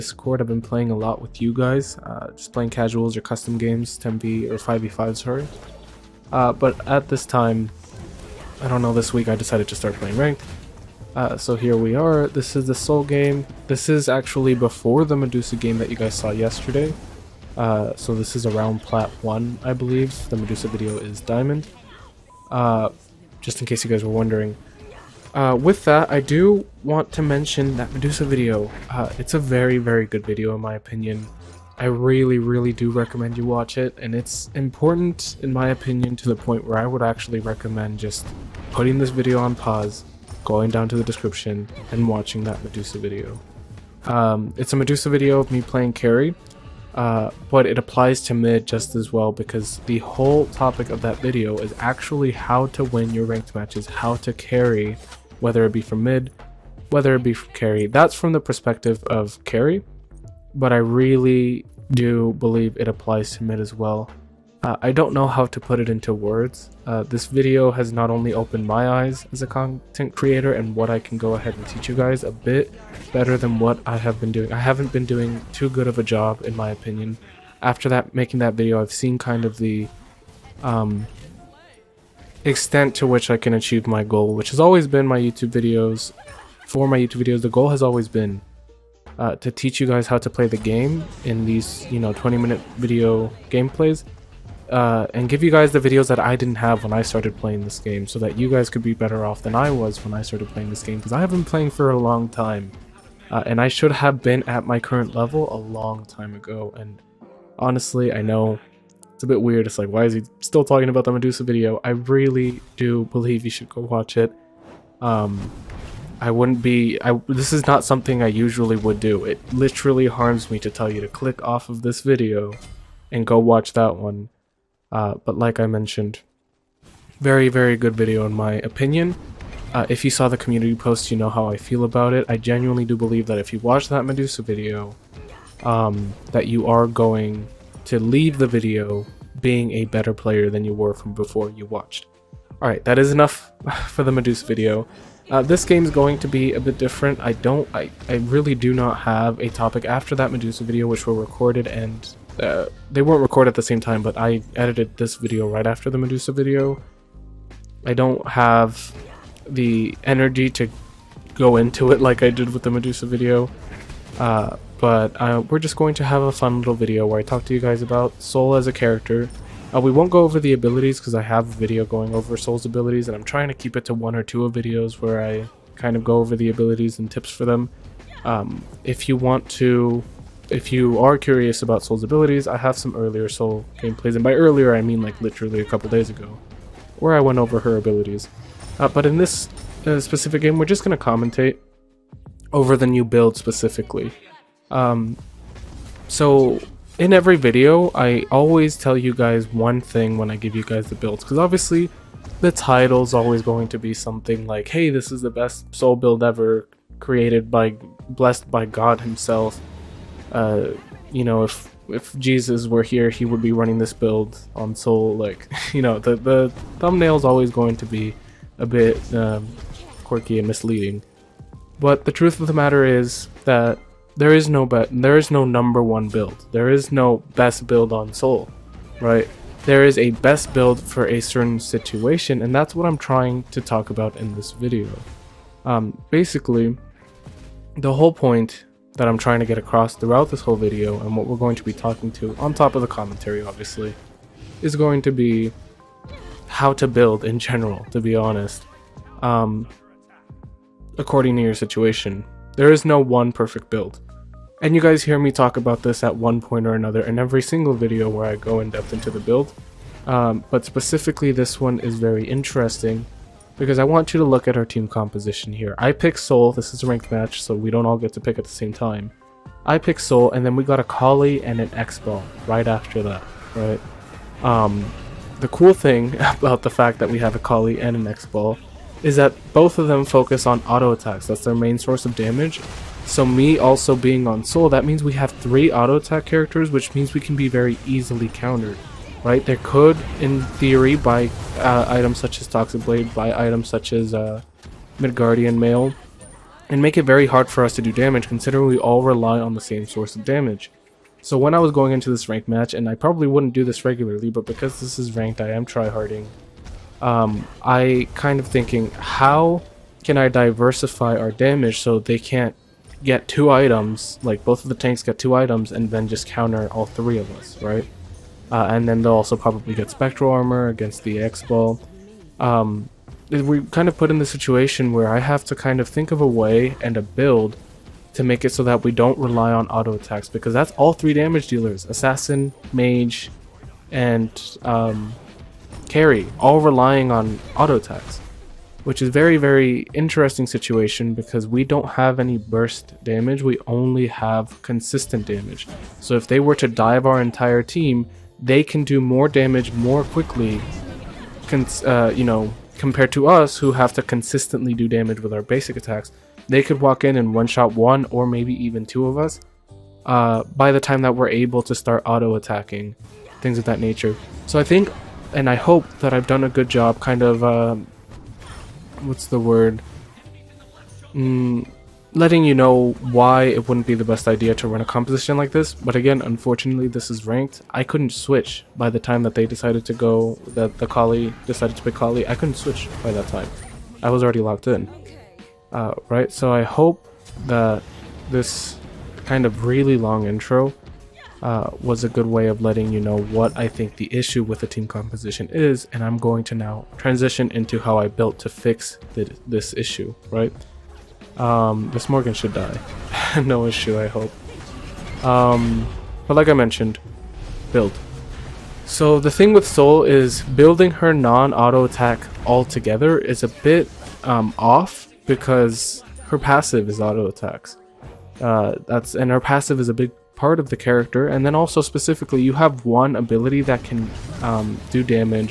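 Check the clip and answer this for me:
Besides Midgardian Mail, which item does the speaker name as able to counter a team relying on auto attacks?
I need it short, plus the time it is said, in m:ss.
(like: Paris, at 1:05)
Toxic Blade, at 4:52.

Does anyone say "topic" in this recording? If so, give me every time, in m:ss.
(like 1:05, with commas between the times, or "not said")
0:50, 2:29.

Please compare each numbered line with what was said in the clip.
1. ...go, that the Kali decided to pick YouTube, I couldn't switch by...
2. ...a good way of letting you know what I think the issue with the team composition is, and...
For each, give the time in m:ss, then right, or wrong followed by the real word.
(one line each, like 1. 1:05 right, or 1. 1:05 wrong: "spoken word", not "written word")
1. 6:19 wrong: "Kali", not "YouTube"
2. 6:32 right.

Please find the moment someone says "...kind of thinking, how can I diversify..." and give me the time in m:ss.
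5:08.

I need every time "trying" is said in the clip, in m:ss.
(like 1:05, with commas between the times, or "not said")
2:53, 3:52, 3:59.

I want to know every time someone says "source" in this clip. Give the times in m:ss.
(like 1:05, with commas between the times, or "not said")
4:41, 4:59.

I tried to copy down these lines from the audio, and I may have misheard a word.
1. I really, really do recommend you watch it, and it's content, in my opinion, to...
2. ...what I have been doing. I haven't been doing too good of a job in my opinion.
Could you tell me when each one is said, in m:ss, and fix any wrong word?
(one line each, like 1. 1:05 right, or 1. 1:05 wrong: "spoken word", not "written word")
1. 0:31 wrong: "important", not "content"
2. 1:13 right.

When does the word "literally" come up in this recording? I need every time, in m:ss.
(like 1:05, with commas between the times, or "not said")
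1:59, 3:05.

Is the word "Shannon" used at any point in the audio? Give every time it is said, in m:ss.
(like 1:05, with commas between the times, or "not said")
not said.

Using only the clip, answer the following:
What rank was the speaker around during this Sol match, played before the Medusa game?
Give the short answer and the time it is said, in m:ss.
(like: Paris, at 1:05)
Plat 1, at 0:18.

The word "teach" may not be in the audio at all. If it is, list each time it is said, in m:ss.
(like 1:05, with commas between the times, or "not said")
1:11, 1:29.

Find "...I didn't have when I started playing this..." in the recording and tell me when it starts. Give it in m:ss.
1:36.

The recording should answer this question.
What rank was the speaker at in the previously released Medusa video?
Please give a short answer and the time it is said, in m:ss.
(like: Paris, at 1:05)
Diamond, at 0:21.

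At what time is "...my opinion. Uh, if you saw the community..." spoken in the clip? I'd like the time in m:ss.
2:08.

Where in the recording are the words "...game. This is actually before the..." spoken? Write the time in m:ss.
0:13.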